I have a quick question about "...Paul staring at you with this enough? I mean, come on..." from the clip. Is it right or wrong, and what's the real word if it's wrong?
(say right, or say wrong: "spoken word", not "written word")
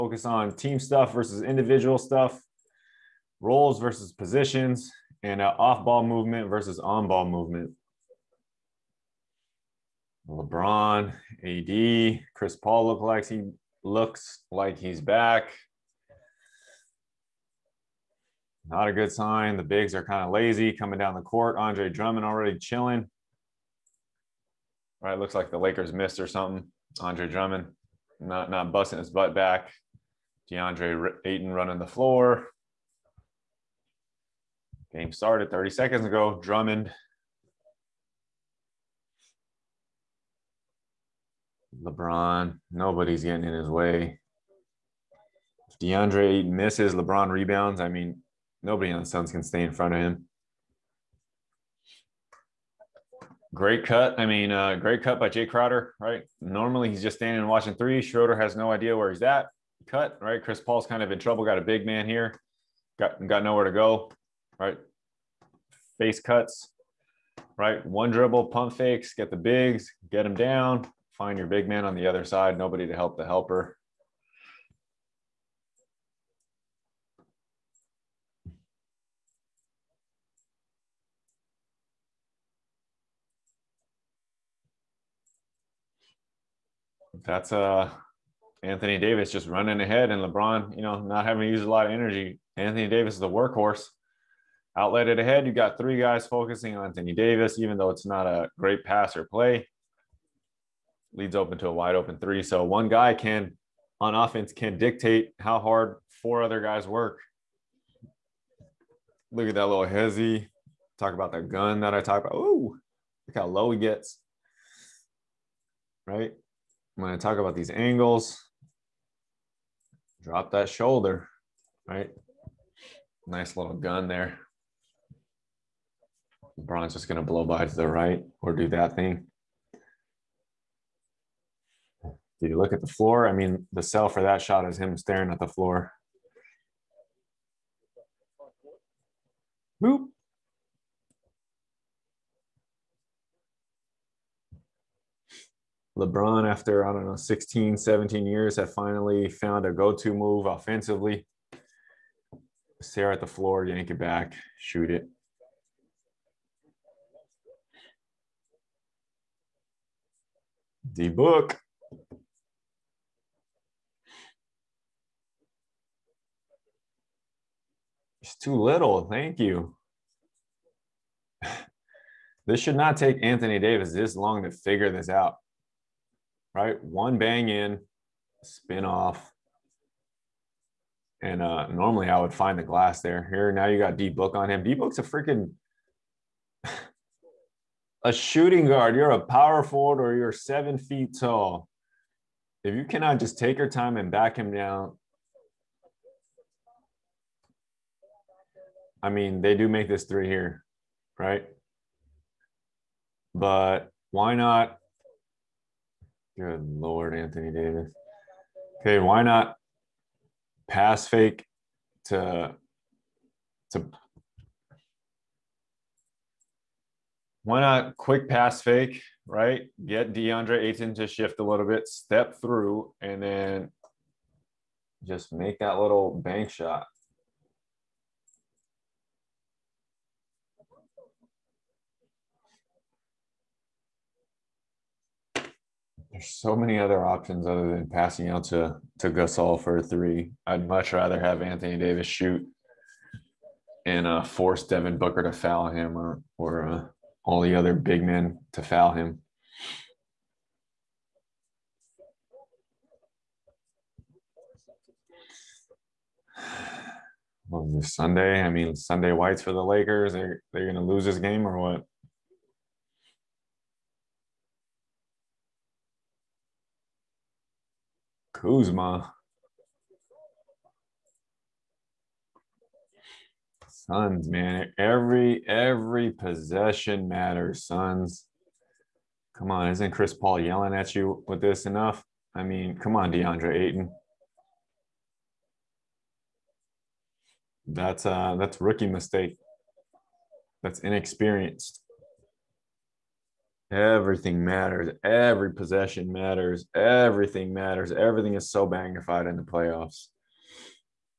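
wrong: "yelling", not "staring".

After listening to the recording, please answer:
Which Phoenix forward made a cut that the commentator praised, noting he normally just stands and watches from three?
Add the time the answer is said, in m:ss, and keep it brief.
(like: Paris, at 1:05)
Jae Crowder, at 0:55.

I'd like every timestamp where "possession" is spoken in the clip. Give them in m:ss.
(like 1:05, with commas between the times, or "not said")
4:36, 4:55.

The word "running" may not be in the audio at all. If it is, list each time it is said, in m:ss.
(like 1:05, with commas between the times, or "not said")
0:31, 1:29.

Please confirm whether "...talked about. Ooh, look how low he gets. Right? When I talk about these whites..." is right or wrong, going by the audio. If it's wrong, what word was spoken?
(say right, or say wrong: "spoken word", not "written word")
wrong: "angles", not "whites".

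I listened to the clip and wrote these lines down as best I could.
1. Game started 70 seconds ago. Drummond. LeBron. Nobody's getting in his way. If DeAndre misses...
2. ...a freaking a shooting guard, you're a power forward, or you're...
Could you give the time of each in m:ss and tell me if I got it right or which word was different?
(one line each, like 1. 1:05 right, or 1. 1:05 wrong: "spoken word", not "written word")
1. 0:34 wrong: "30", not "70"
2. 3:04 right.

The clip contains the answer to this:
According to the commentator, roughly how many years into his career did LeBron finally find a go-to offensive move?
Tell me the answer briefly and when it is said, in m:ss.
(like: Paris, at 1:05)
16 or 17, at 2:27.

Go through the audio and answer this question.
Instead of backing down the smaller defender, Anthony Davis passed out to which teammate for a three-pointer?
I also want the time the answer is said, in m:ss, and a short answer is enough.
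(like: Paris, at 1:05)
Gasol, at 3:59.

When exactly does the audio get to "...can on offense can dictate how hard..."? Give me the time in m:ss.
1:43.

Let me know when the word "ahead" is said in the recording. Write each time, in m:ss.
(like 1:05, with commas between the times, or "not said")
1:29, 1:35.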